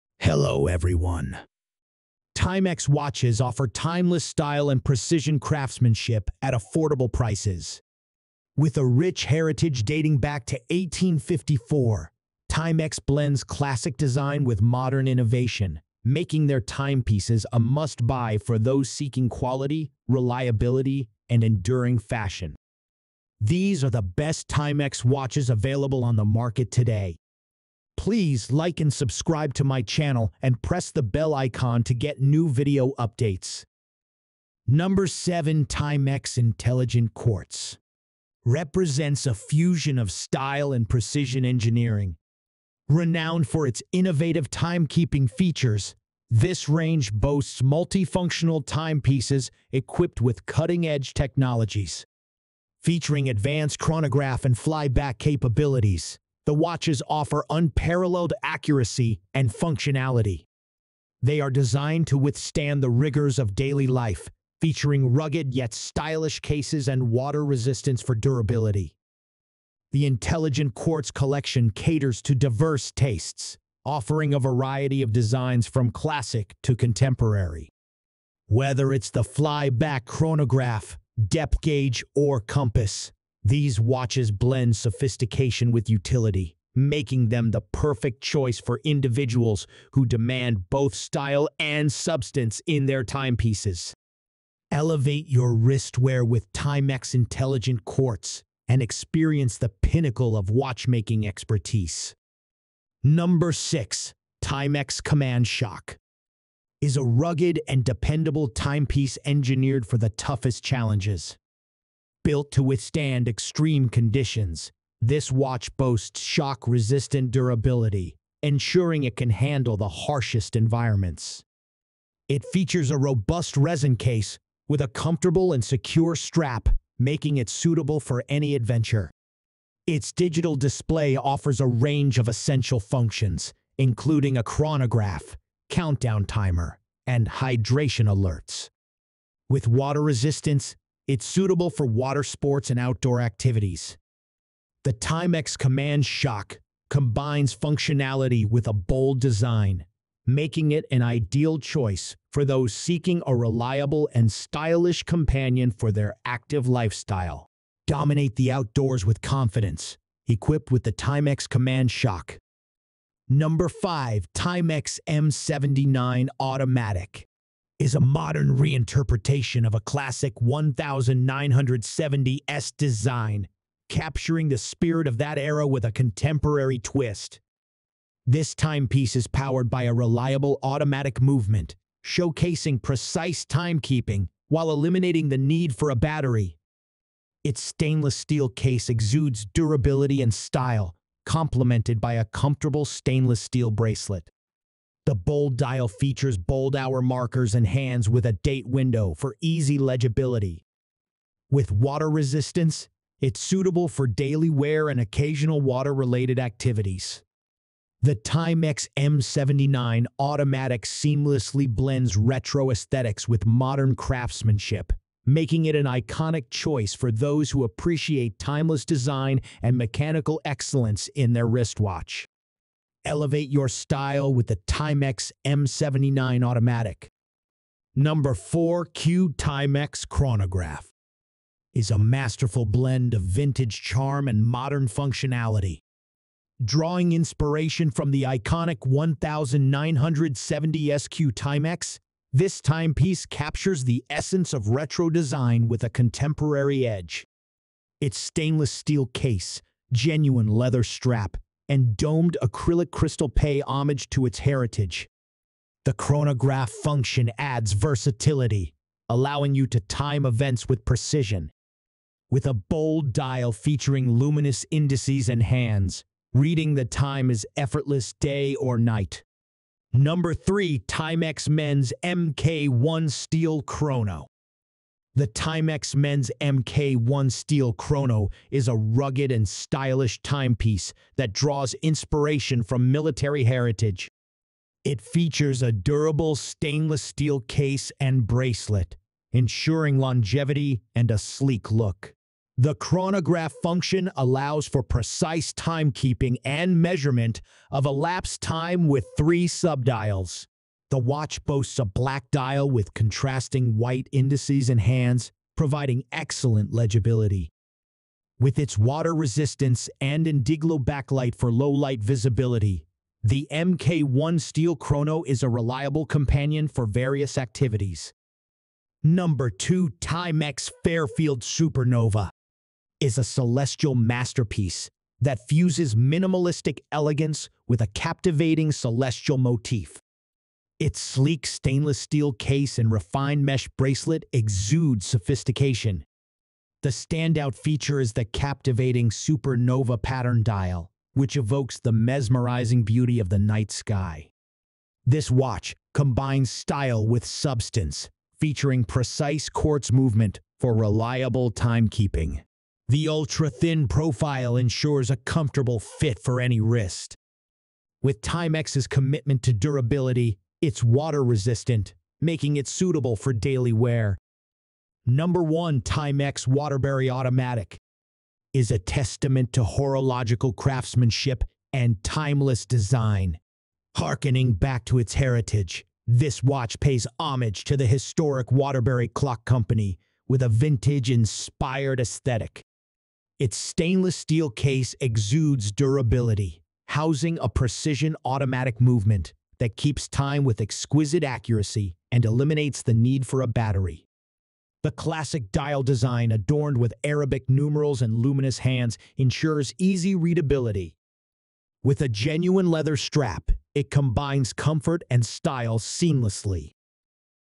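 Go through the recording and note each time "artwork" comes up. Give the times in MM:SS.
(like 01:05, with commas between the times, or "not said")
not said.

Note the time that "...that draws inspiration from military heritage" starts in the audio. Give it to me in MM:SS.
04:41.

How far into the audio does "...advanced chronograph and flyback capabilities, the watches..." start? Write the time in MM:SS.
00:53.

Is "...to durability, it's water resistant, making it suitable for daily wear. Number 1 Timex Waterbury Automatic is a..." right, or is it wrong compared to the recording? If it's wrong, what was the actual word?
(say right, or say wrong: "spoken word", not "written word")
right.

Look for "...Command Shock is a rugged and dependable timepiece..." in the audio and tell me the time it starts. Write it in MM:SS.
01:45.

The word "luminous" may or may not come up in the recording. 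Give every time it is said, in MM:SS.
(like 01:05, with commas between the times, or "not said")
04:24, 06:38.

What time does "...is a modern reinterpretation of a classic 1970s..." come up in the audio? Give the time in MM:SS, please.
02:47.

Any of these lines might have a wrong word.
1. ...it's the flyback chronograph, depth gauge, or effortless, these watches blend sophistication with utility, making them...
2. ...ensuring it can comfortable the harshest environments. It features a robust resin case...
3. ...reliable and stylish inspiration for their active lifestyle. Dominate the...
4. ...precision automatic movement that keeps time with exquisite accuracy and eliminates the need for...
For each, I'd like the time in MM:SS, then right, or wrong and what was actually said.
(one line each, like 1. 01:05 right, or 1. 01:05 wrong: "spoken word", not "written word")
1. 01:18 wrong: "compass", not "effortless"
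2. 01:58 wrong: "handle", not "comfortable"
3. 02:33 wrong: "companion", not "inspiration"
4. 06:27 right.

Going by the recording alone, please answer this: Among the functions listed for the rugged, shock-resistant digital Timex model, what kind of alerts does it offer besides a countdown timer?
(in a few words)
hydration alerts.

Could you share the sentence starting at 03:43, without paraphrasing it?
Elevate your style with the Timex M79 automatic.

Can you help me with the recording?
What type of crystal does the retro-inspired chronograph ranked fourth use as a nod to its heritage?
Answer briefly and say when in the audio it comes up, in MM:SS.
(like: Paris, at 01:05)
domed acrylic, at 04:11.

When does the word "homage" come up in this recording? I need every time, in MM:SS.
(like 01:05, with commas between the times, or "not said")
04:13, 06:17.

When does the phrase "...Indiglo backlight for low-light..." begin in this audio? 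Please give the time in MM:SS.
05:10.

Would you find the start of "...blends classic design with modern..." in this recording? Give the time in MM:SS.
00:13.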